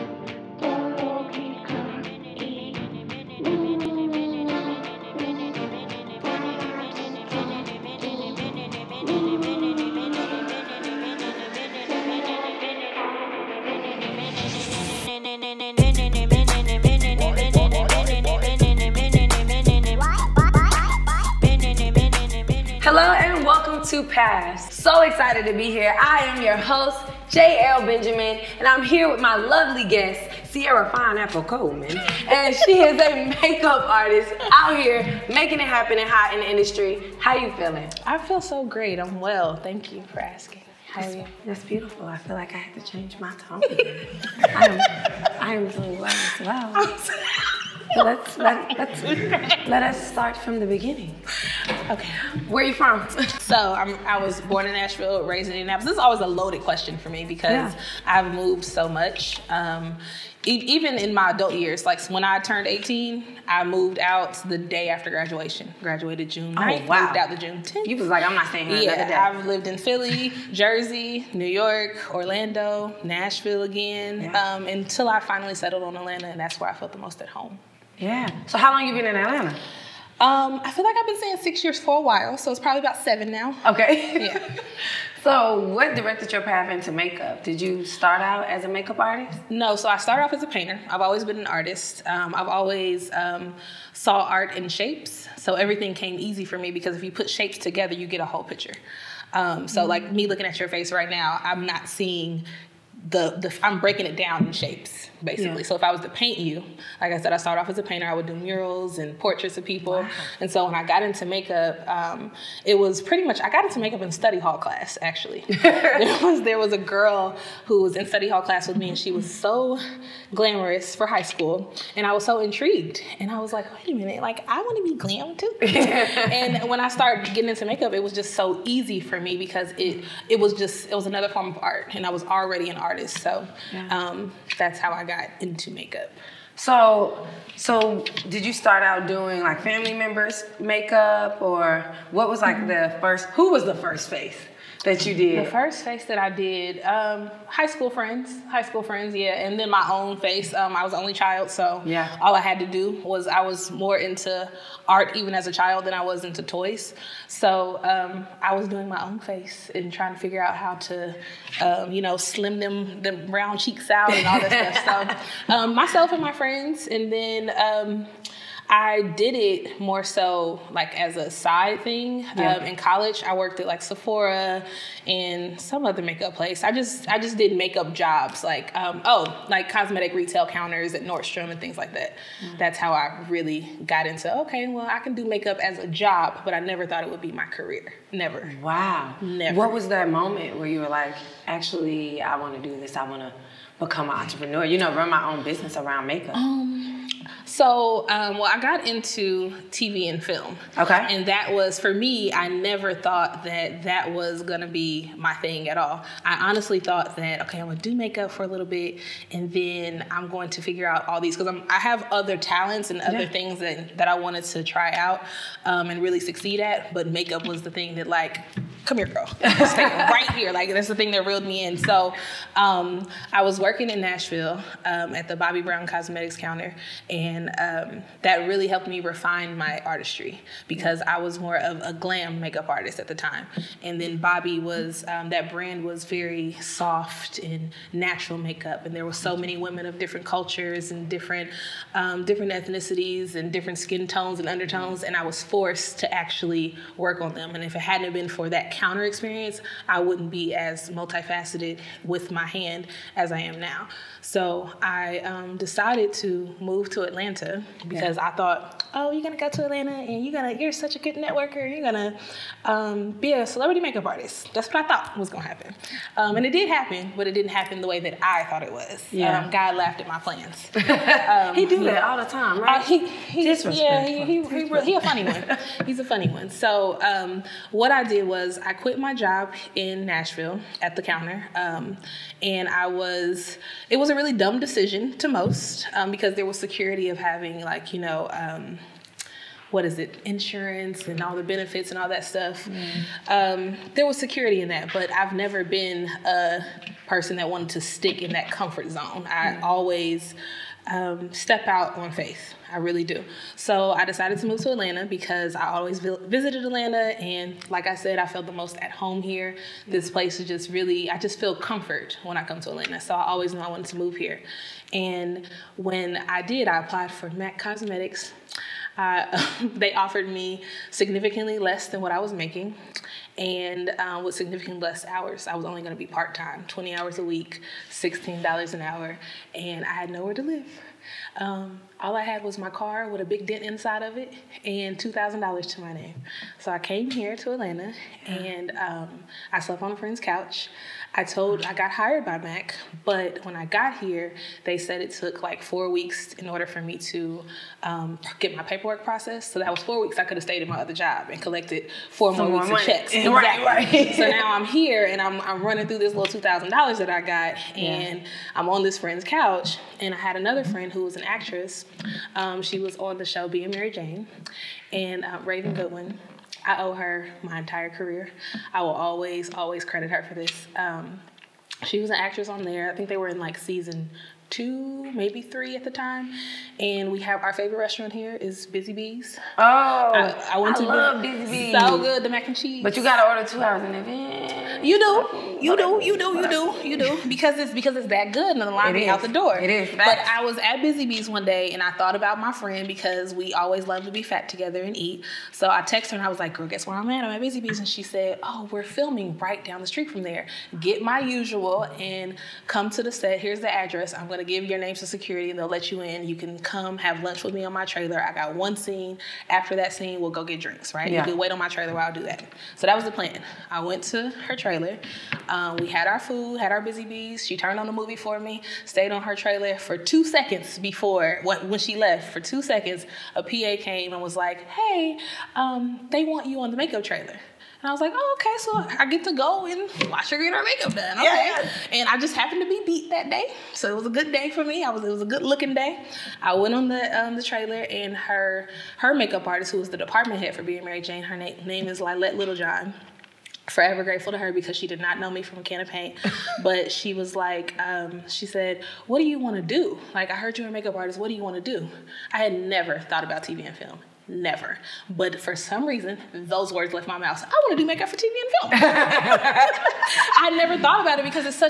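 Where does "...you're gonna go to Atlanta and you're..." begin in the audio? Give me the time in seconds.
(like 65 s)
259 s.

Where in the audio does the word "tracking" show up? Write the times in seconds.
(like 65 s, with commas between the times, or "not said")
not said.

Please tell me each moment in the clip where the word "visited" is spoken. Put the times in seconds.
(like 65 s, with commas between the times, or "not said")
305 s.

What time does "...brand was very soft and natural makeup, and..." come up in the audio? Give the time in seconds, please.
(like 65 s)
235 s.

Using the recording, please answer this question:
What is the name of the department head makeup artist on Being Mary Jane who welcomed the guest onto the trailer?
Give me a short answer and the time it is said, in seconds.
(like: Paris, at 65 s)
Lalette Littlejohn, at 442 s.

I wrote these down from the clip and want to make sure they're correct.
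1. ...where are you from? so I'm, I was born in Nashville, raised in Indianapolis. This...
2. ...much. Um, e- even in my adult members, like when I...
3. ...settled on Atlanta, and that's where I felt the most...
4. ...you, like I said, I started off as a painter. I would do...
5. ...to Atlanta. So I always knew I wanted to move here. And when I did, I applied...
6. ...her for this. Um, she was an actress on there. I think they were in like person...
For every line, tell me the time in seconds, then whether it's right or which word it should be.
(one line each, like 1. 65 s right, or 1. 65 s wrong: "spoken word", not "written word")
1. 52 s right
2. 58 s wrong: "years", not "members"
3. 75 s right
4. 106 s right
5. 312 s right
6. 370 s wrong: "season", not "person".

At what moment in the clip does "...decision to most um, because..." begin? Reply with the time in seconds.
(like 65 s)
284 s.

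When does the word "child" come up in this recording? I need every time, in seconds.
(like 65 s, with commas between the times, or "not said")
151 s, 155 s.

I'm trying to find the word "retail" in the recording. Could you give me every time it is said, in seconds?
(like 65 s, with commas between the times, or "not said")
180 s.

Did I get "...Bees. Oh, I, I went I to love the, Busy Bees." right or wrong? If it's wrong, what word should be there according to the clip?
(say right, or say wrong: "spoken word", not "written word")
right.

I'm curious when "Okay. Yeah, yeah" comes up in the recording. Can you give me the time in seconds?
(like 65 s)
431 s.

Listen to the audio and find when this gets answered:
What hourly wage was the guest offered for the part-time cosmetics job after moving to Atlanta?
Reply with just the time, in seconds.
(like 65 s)
327 s.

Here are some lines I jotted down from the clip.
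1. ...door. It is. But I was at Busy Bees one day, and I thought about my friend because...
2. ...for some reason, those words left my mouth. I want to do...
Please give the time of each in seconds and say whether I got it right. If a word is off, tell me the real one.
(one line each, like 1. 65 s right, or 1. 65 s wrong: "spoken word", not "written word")
1. 389 s right
2. 455 s right.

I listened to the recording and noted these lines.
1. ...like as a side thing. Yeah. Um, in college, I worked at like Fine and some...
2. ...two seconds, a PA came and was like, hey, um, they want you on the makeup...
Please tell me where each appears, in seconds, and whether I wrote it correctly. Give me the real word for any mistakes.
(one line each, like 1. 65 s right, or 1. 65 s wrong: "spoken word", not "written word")
1. 170 s wrong: "Sephora", not "Fine"
2. 422 s right.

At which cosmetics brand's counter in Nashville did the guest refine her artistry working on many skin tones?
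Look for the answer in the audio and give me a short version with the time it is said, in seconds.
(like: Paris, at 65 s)
Bobbi Brown, at 225 s.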